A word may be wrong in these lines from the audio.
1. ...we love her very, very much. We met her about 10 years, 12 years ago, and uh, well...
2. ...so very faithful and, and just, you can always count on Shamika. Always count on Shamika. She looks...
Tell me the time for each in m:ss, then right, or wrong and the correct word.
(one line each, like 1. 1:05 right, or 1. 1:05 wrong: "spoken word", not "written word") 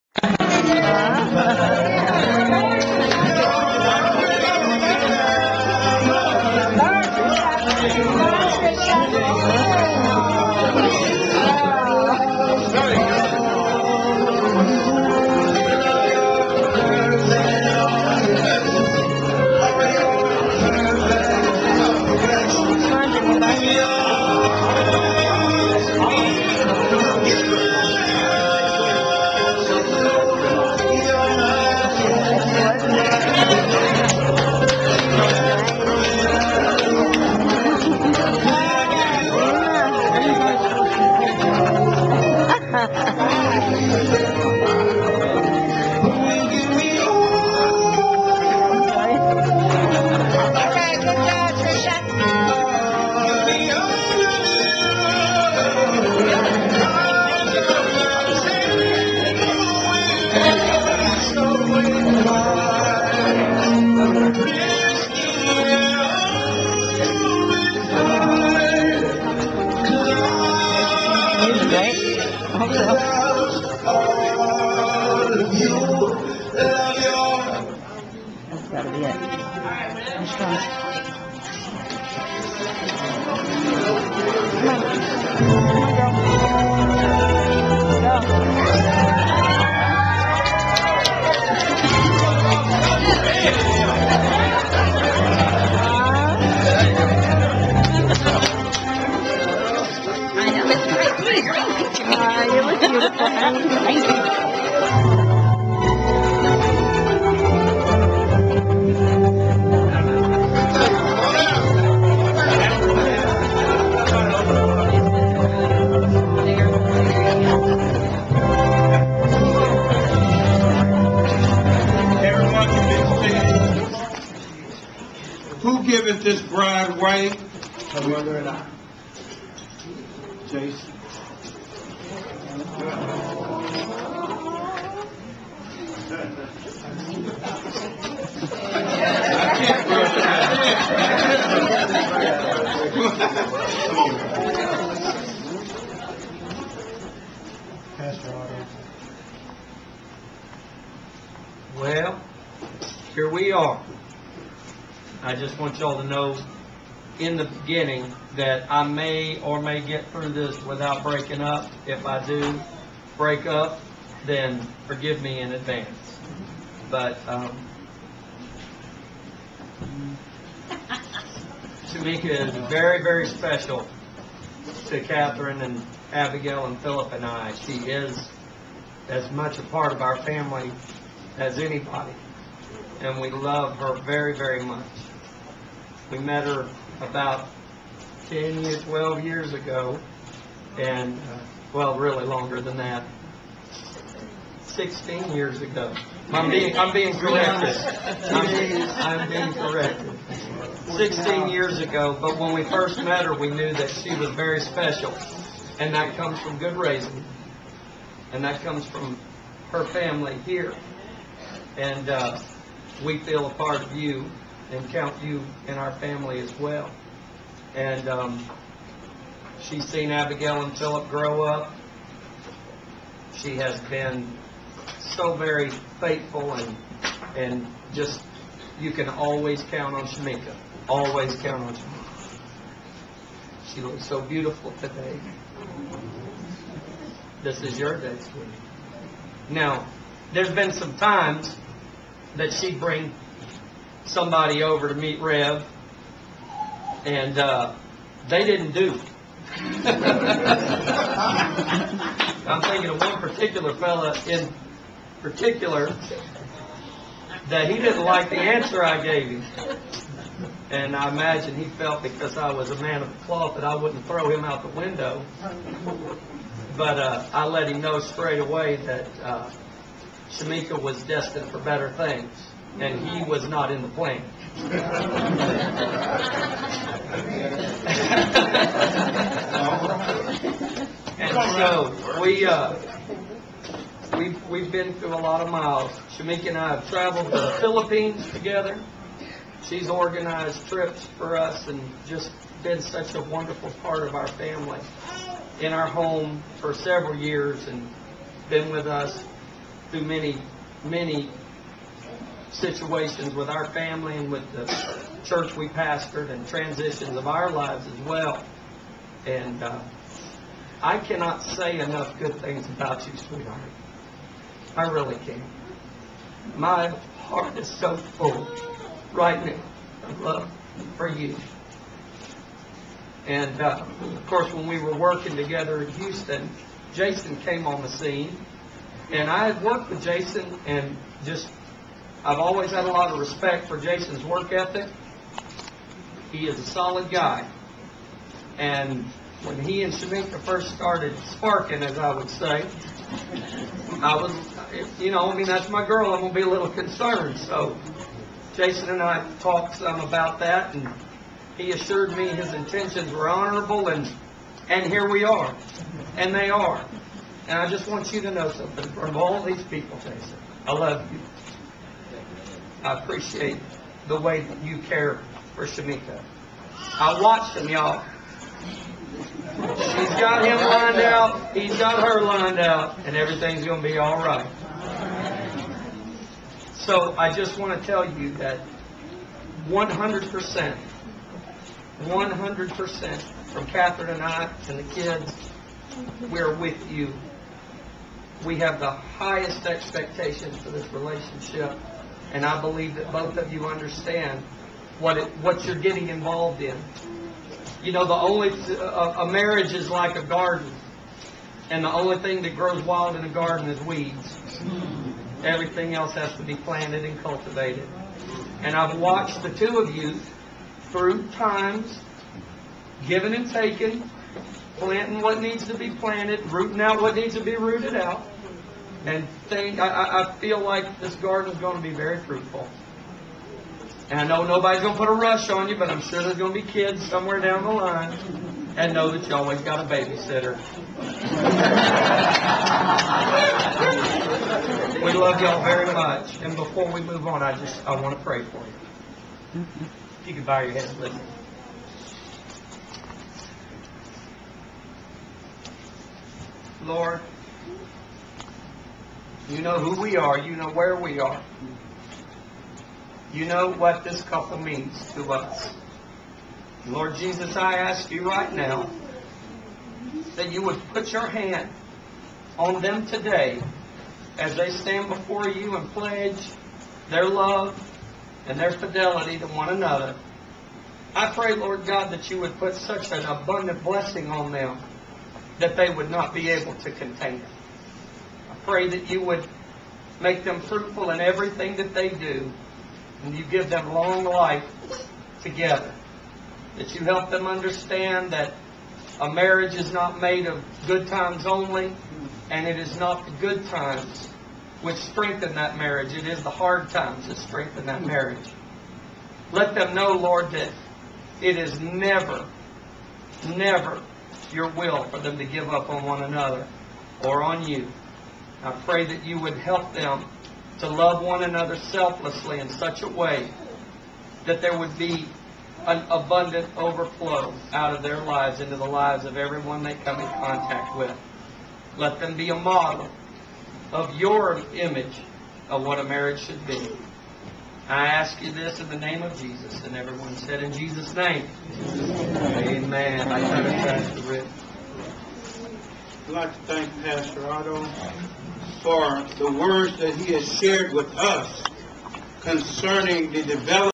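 1. 3:03 right
2. 3:44 right.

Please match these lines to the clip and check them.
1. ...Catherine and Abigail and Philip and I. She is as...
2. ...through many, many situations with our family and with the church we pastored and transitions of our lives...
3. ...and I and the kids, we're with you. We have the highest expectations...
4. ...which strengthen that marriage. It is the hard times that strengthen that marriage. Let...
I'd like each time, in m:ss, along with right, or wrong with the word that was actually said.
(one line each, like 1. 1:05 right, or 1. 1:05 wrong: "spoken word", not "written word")
1. 2:54 right
2. 4:59 right
3. 6:24 right
4. 8:14 right.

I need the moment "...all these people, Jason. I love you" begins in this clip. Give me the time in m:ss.
5:59.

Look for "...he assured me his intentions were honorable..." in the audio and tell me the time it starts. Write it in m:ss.
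5:51.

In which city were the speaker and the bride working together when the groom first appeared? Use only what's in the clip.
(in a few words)
Houston.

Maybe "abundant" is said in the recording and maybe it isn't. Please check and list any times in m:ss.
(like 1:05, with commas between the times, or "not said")
7:53, 8:36.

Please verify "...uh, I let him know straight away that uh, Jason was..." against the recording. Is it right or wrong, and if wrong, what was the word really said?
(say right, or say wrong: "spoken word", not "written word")
wrong: "Shamika", not "Jason".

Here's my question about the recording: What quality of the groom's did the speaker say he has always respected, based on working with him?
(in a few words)
Work ethic.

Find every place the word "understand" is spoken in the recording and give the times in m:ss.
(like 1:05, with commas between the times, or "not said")
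6:33, 8:07.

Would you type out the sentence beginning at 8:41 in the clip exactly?
Let them be a model of your image of what a marriage should be.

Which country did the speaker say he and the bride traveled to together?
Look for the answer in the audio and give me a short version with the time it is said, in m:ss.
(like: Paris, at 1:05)
Philippines, at 4:47.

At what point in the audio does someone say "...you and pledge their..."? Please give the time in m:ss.
7:45.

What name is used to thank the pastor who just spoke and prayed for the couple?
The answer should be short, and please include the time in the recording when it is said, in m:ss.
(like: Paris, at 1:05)
Pastor Otto, at 8:57.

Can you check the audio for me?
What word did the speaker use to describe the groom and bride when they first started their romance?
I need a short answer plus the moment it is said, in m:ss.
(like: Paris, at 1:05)
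Sparking, at 5:41.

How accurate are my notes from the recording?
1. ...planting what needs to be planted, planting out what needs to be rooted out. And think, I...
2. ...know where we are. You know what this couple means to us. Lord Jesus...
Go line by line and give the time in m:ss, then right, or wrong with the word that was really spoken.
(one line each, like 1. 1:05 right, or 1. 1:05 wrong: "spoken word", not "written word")
1. 6:54 wrong: "rooting", not "planting"
2. 7:30 right.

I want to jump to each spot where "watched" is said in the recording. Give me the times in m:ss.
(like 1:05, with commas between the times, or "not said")
6:07, 6:48.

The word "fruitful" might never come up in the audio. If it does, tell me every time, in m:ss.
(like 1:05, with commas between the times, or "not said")
7:02, 8:00.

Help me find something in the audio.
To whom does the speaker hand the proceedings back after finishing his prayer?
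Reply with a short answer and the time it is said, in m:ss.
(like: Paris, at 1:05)
Rick, at 8:54.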